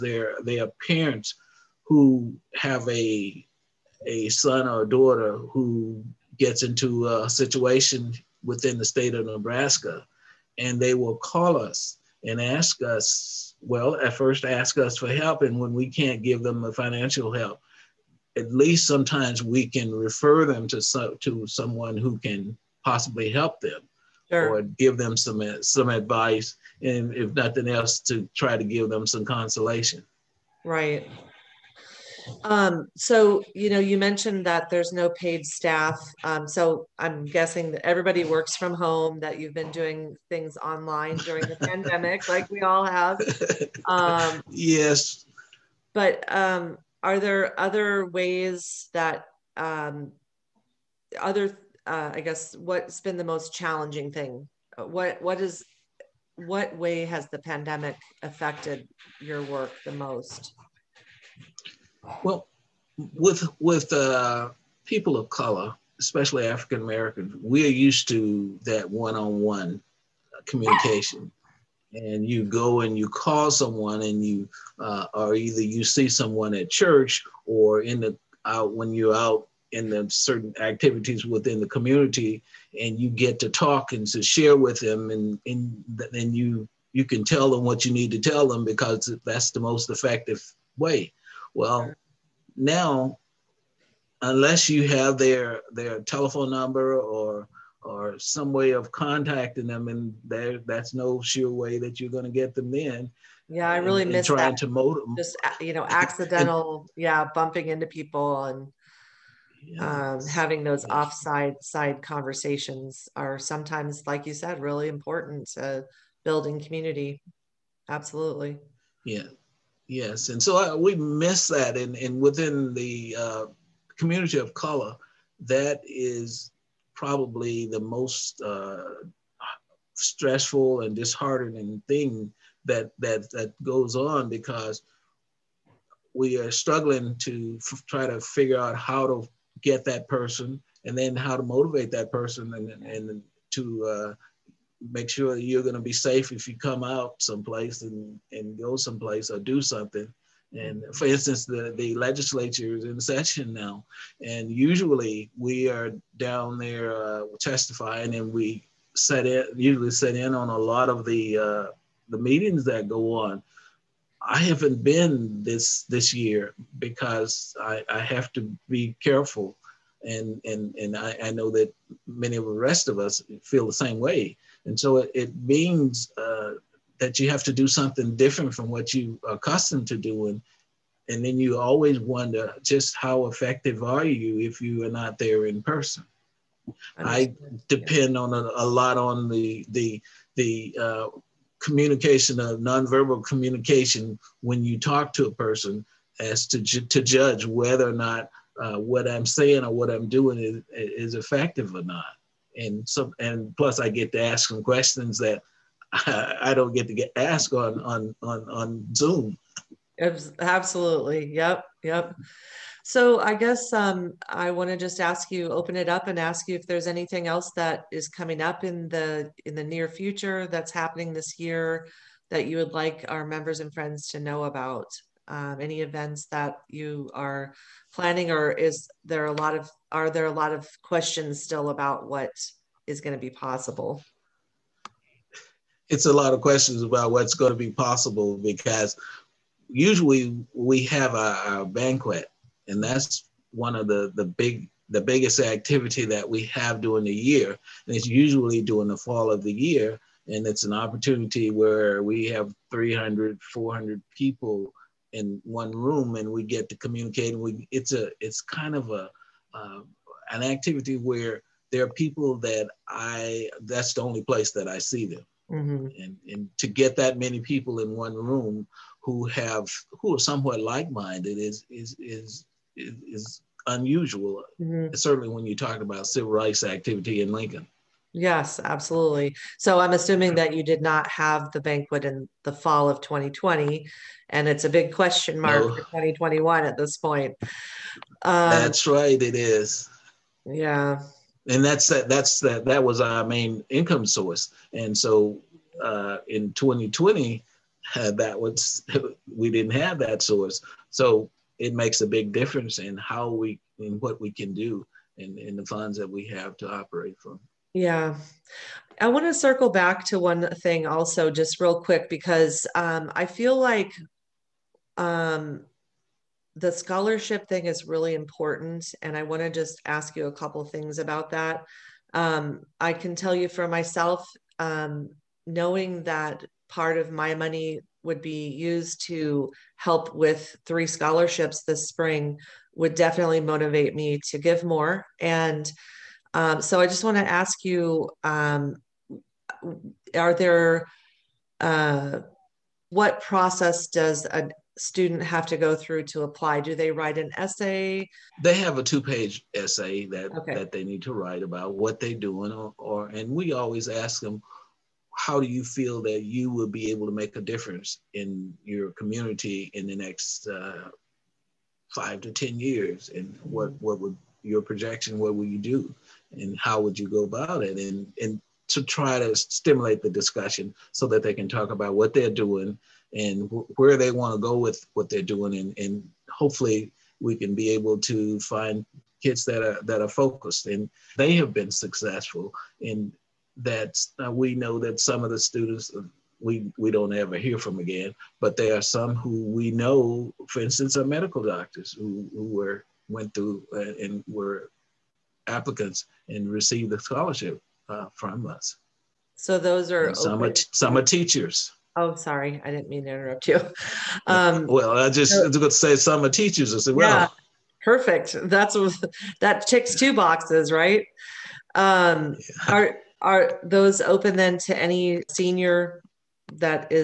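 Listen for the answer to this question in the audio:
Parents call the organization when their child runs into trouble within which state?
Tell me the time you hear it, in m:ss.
0:09.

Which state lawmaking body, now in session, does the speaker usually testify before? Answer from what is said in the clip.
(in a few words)
The legislature.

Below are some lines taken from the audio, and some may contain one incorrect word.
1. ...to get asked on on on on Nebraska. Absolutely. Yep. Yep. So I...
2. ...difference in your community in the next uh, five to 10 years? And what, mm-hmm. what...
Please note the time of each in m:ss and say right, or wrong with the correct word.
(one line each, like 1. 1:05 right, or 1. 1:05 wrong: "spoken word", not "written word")
1. 3:26 wrong: "Zoom", not "Nebraska"
2. 5:57 right.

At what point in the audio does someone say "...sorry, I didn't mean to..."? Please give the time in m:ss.
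6:42.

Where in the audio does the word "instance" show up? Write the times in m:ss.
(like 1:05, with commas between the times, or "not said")
2:31, 6:30.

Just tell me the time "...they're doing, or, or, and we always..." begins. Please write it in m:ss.
5:51.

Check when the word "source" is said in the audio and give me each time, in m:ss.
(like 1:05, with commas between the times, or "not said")
4:54, 5:00.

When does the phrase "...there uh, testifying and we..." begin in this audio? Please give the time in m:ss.
2:36.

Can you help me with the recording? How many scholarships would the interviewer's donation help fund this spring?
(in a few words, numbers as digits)
3.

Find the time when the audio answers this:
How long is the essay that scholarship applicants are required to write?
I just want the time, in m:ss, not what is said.
5:48.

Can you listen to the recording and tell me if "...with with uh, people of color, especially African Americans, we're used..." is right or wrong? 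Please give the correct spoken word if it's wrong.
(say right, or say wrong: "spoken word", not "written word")
right.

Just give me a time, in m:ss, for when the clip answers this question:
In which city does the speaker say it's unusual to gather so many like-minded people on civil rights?
4:37.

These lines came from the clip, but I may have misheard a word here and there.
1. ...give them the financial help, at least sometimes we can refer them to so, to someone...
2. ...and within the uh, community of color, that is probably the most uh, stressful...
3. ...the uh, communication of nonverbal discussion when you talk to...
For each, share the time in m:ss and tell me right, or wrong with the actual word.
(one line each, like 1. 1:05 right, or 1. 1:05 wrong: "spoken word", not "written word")
1. 0:16 right
2. 2:01 right
3. 3:10 wrong: "communication", not "discussion".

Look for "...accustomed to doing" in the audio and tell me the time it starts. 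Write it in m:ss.
2:59.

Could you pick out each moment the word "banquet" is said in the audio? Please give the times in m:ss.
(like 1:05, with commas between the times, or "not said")
4:01, 4:41.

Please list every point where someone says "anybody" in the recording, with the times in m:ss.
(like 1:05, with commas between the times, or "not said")
not said.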